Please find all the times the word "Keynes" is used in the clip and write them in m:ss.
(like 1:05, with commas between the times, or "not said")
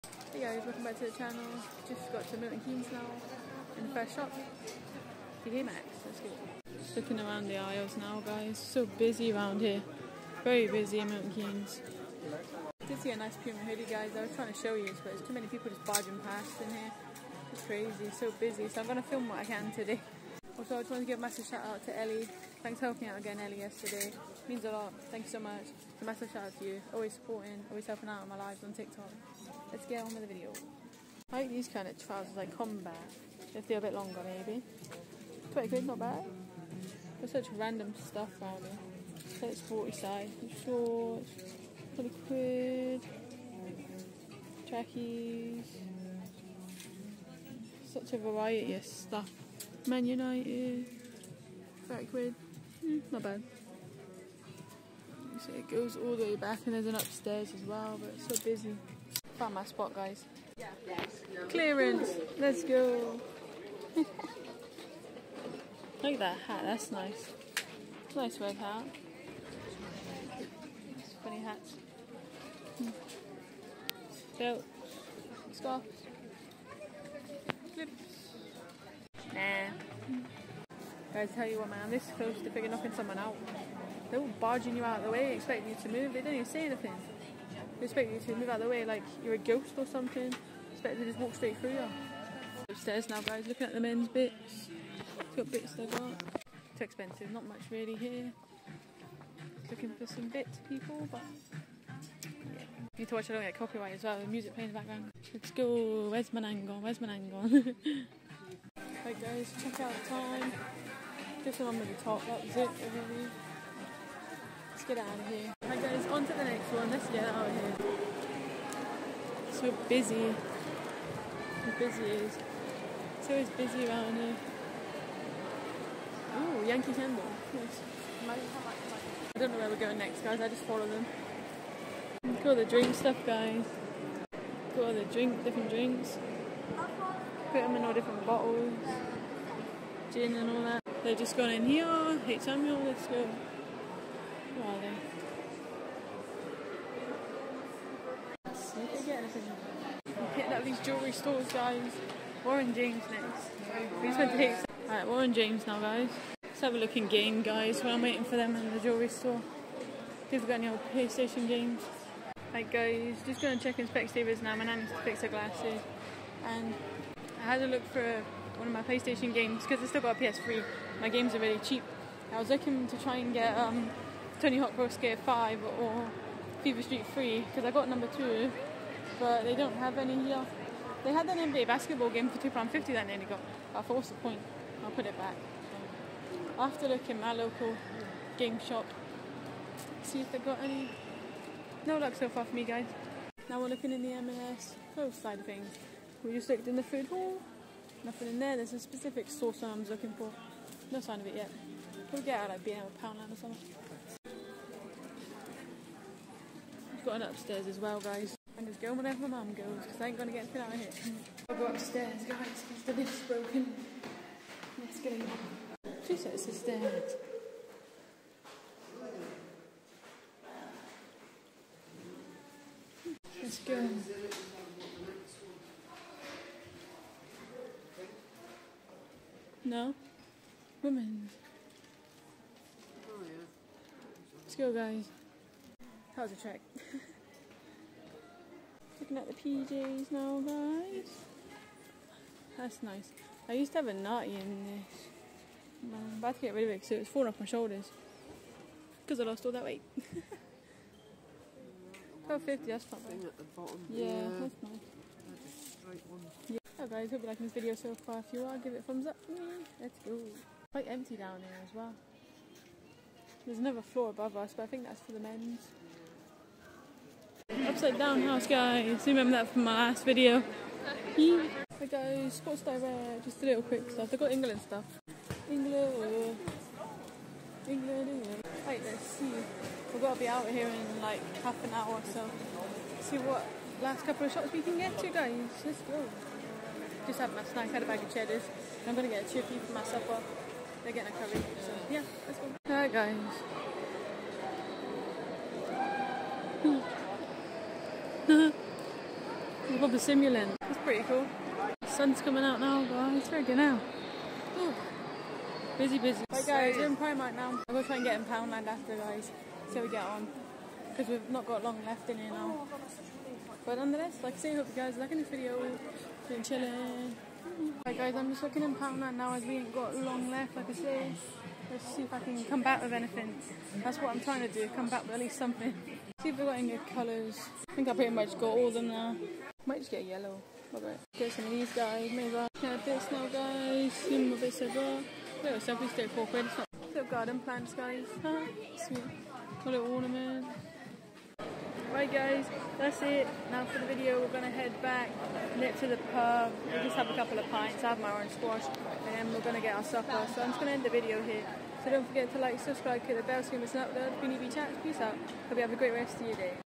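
0:02, 0:11.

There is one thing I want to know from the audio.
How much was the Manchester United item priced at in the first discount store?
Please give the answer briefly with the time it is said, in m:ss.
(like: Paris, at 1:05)
£30, at 0:51.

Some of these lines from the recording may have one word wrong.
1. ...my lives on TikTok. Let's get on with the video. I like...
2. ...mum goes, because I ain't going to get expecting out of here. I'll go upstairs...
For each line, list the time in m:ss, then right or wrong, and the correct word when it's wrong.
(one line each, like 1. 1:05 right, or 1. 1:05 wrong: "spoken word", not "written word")
1. 0:28 right
2. 3:29 wrong: "anything", not "expecting".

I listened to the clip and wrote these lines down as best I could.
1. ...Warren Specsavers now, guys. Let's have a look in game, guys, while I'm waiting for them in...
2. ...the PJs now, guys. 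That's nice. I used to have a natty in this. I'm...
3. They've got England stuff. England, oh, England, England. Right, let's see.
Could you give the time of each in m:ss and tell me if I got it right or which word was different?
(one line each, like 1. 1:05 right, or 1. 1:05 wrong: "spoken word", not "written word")
1. 2:35 wrong: "James", not "Specsavers"
2. 3:59 right
3. 4:34 right.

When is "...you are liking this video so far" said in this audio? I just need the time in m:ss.
4:17.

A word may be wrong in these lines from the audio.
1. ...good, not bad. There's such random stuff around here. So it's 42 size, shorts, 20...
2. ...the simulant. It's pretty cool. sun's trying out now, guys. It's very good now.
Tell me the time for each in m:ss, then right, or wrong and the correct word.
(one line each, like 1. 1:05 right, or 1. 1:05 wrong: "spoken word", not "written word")
1. 0:35 wrong: "40", not "42"
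2. 4:59 wrong: "coming", not "trying".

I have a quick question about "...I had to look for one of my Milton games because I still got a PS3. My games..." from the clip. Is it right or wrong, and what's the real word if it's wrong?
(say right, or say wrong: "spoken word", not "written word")
wrong: "PlayStation", not "Milton".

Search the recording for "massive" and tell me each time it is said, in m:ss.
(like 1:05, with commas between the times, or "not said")
0:21, 0:26.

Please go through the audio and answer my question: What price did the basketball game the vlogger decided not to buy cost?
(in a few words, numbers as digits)
£2.50.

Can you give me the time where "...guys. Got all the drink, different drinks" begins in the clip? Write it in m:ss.
2:13.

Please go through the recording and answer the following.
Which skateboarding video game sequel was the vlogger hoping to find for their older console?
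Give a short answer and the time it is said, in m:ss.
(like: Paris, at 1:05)
Tony Hawk Pro Skater 5, at 2:54.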